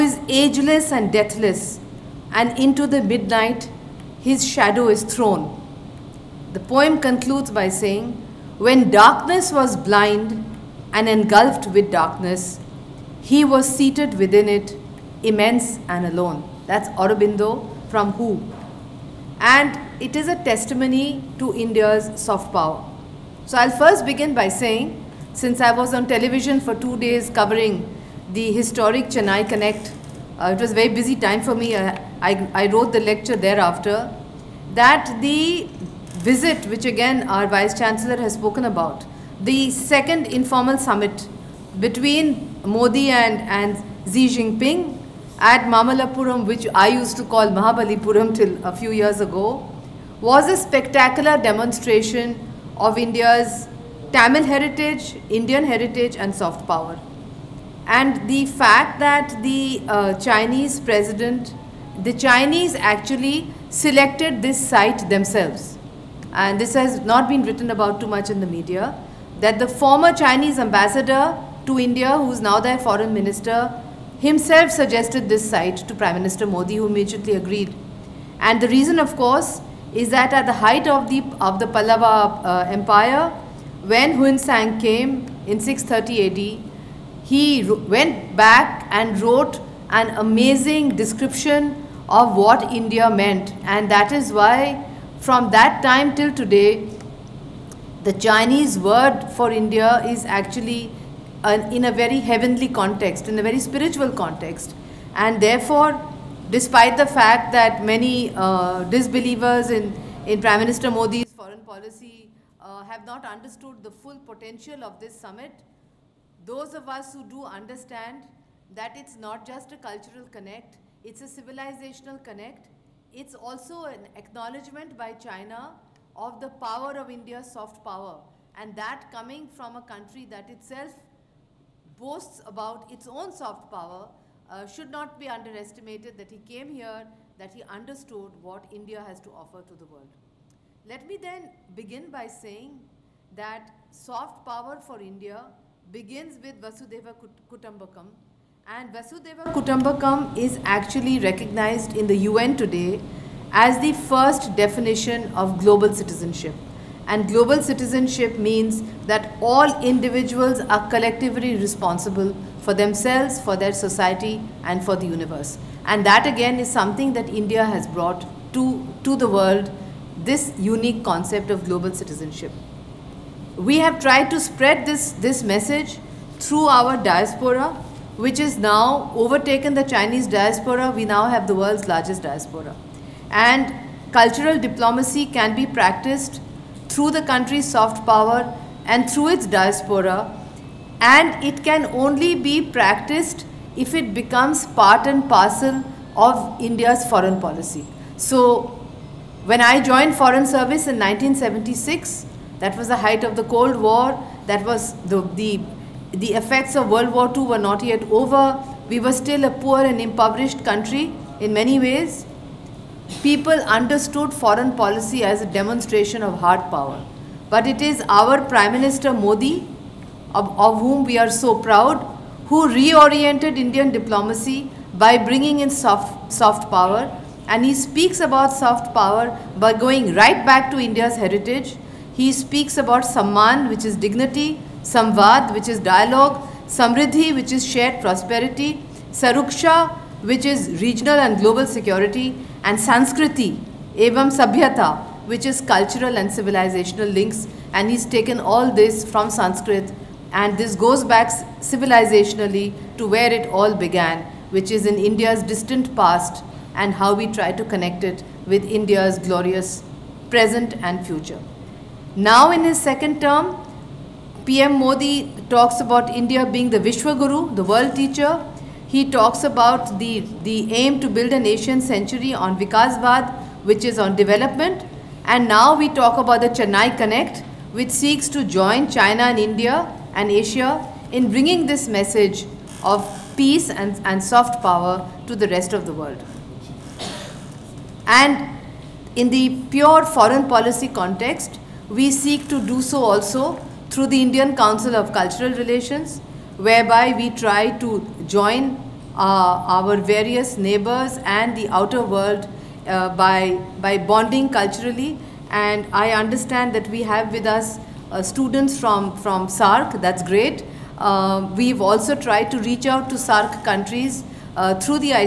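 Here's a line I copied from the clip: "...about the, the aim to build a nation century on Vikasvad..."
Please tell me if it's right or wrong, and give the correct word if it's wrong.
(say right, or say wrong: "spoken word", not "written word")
right.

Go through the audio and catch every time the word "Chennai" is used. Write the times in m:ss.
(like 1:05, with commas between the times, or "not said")
0:29, 4:36.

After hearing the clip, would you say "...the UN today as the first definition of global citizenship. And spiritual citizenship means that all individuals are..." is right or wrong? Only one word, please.
wrong.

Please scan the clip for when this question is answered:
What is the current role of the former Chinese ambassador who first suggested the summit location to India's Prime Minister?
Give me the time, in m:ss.
1:12.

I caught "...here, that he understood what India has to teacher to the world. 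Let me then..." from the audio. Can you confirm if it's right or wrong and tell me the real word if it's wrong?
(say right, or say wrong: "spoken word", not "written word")
wrong: "offer", not "teacher".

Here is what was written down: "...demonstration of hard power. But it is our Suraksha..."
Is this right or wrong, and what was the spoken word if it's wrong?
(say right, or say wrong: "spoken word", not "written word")
wrong: "Prime", not "Suraksha".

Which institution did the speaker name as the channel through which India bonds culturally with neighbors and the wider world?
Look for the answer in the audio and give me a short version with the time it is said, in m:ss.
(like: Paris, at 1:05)
Indian Council of Cultural Relations, at 4:54.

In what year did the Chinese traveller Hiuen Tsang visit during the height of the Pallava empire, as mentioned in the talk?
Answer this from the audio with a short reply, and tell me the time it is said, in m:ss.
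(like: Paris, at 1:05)
630 AD, at 1:25.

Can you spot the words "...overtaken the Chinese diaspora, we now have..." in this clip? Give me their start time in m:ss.
2:59.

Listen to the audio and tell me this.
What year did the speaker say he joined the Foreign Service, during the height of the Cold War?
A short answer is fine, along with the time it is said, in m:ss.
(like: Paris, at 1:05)
1976, at 3:20.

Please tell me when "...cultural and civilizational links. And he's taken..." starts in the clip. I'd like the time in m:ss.
4:05.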